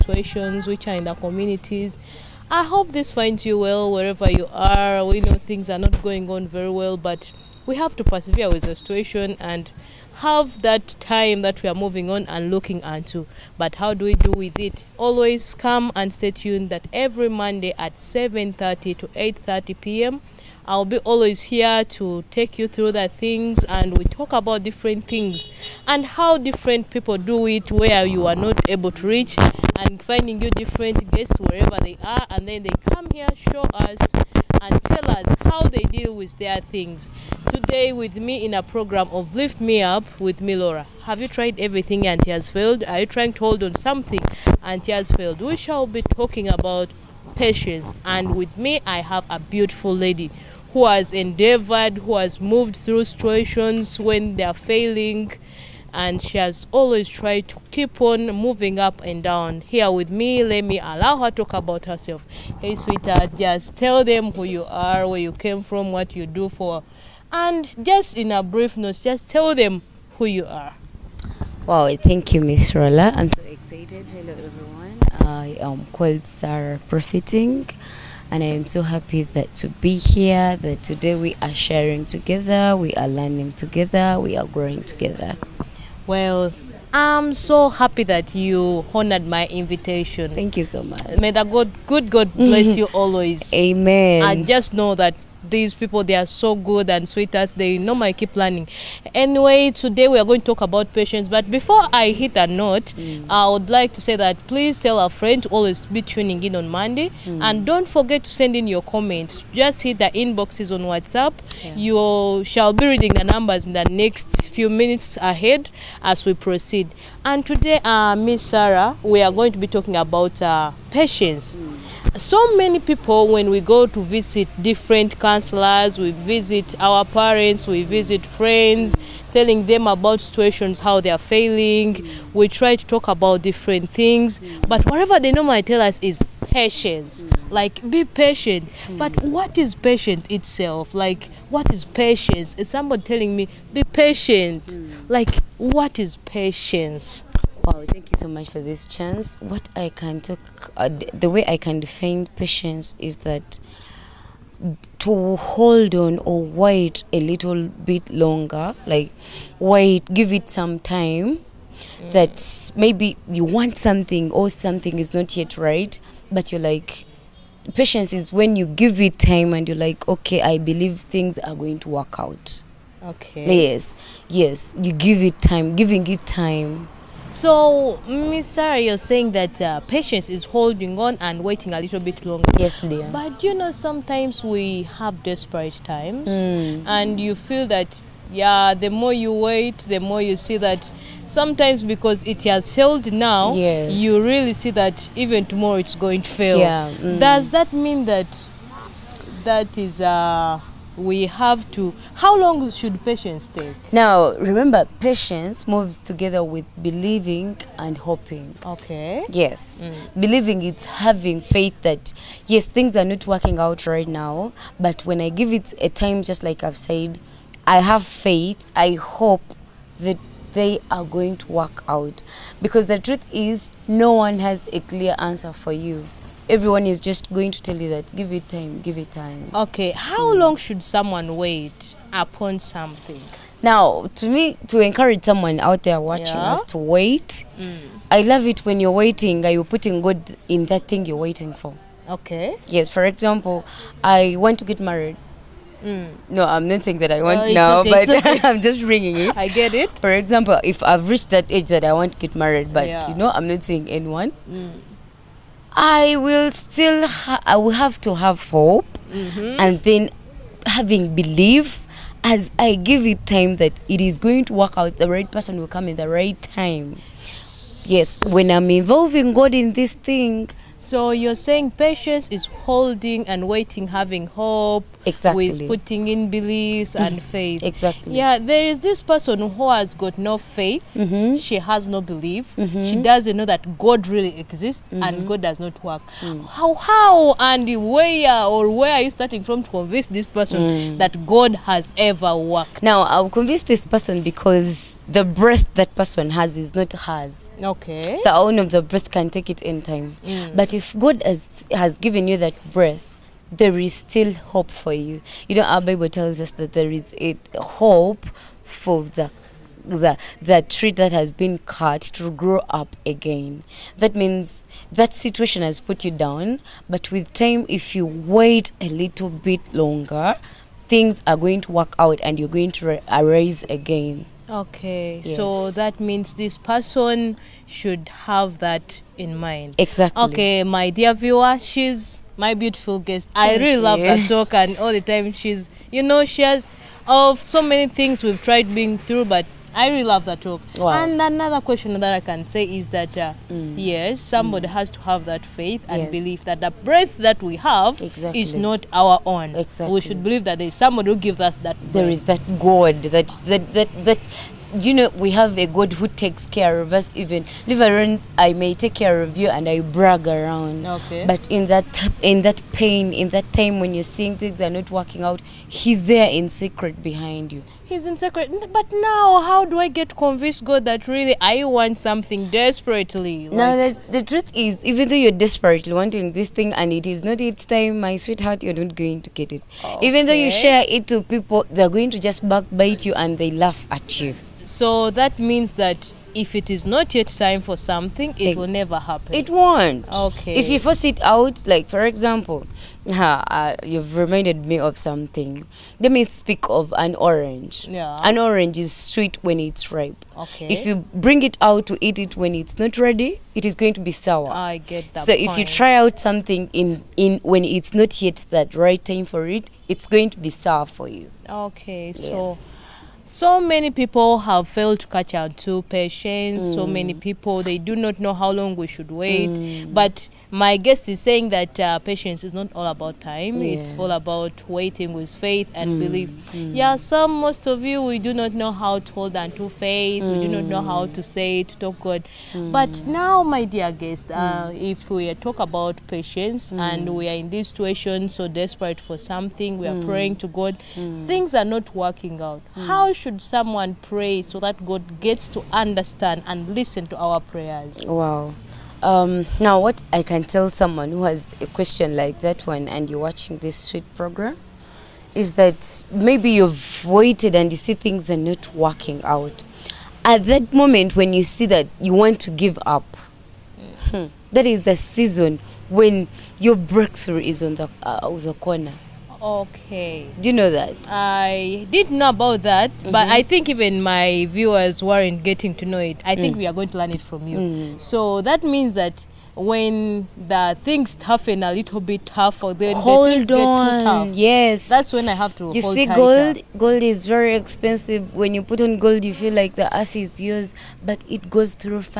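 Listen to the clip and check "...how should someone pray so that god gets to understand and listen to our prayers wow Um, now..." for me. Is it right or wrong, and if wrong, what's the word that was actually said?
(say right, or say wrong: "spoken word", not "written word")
right.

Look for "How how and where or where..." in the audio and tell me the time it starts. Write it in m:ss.
4:46.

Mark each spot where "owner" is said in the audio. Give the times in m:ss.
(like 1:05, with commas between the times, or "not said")
4:58.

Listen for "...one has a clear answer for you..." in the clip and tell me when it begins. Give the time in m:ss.
3:44.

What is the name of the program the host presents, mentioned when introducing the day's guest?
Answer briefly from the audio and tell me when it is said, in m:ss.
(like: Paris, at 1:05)
Lift Me Up, at 0:39.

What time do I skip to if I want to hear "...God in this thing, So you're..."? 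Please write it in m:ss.
4:29.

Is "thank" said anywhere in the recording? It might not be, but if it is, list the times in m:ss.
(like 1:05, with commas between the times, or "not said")
1:11, 1:30, 2:27, 5:33.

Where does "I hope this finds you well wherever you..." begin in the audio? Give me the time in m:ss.
0:02.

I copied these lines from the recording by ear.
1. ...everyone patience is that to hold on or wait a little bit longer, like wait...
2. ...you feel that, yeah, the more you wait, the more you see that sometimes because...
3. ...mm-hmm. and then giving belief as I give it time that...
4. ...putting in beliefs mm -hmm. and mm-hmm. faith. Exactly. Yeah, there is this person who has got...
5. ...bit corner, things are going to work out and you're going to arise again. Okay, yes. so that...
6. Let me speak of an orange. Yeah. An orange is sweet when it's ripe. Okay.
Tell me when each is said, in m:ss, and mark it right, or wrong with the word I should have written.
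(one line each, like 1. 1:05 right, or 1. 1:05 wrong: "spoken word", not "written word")
1. 2:31 wrong: "define", not "everyone"
2. 3:07 right
3. 4:19 wrong: "having", not "giving"
4. 4:35 right
5. 5:19 wrong: "longer", not "corner"
6. 6:35 right.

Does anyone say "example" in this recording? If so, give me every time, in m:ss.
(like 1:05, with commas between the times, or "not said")
4:03, 4:10, 6:32.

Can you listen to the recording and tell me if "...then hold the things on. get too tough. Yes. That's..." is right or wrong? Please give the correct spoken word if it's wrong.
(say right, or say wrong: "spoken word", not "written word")
right.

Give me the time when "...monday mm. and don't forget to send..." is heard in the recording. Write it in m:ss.
1:46.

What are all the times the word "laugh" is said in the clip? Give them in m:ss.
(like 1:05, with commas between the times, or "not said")
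6:23.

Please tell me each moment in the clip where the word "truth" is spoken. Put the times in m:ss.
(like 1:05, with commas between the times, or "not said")
3:42, 6:14.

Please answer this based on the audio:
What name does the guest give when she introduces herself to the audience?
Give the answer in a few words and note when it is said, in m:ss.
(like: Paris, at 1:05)
Sarah Profiting, at 1:16.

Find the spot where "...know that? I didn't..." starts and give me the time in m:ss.
7:50.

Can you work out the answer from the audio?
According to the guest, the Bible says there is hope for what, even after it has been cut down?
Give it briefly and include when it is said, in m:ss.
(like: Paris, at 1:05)
The tree, at 5:10.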